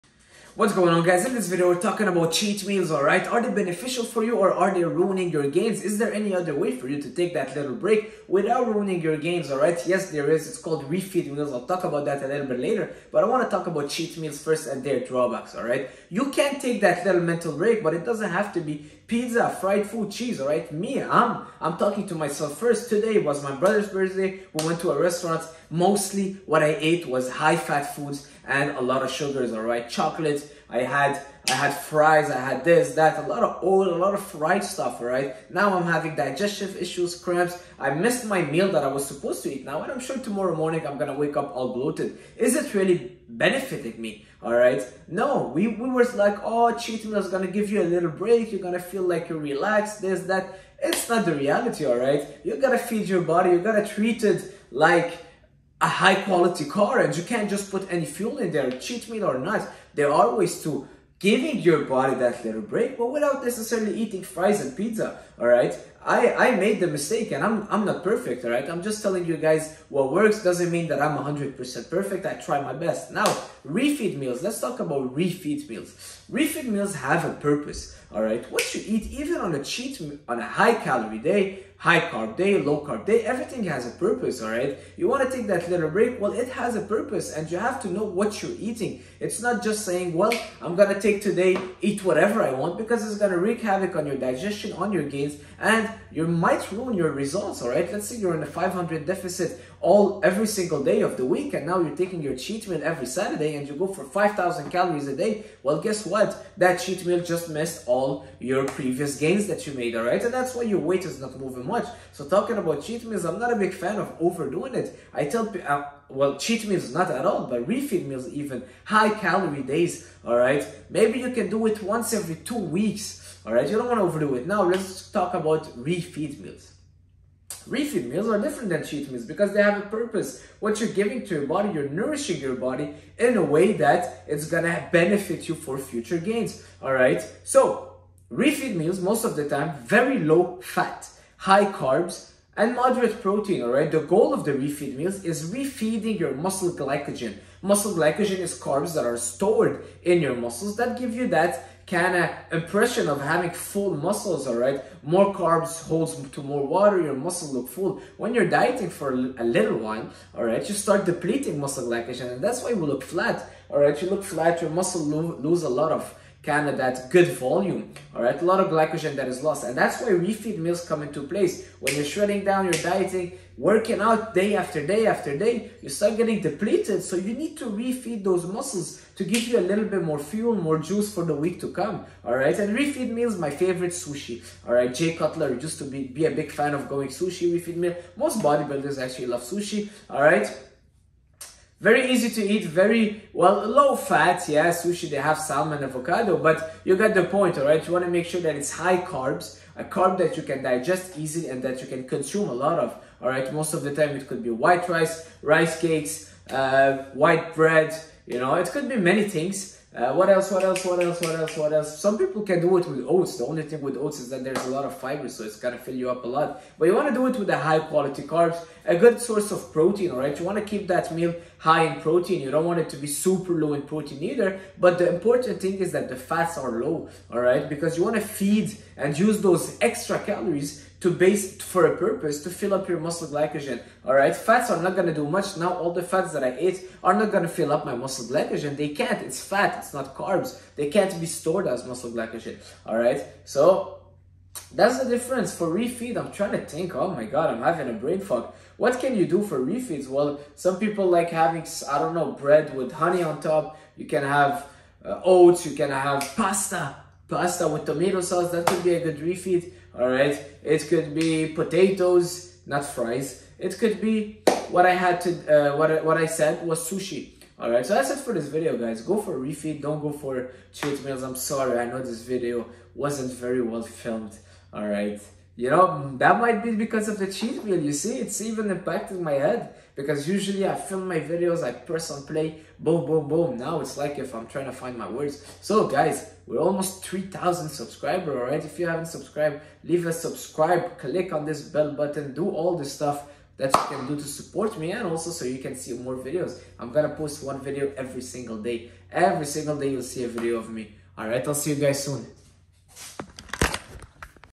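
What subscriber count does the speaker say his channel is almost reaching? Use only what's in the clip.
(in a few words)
3,000.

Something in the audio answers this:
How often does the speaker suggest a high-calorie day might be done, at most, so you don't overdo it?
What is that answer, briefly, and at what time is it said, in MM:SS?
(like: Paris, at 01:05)
once every two weeks, at 02:01.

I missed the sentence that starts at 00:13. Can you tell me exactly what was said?
But I want to talk about cheat meals first and their drawbacks, alright?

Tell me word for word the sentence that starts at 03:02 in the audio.
And refeed meals, my favorite sushi, all right?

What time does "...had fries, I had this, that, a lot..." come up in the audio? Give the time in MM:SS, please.
00:31.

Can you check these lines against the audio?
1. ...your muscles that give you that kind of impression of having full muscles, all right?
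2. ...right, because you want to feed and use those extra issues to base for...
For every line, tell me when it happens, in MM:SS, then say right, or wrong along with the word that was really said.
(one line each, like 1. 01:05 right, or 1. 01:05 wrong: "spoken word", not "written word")
1. 02:30 right
2. 03:47 wrong: "calories", not "issues".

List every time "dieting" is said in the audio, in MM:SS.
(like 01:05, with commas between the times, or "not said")
02:38, 02:52.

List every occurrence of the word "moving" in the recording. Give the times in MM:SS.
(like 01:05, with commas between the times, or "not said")
01:51.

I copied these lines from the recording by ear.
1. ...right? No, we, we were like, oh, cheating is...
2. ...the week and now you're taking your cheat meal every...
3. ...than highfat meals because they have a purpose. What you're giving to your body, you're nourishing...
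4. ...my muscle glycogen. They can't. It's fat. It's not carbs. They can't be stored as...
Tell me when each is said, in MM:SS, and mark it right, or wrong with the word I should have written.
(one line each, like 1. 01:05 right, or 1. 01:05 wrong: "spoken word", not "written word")
1. 00:44 right
2. 01:41 right
3. 02:08 wrong: "cheat", not "highfat"
4. 03:57 right.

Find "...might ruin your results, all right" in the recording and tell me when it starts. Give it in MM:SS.
01:36.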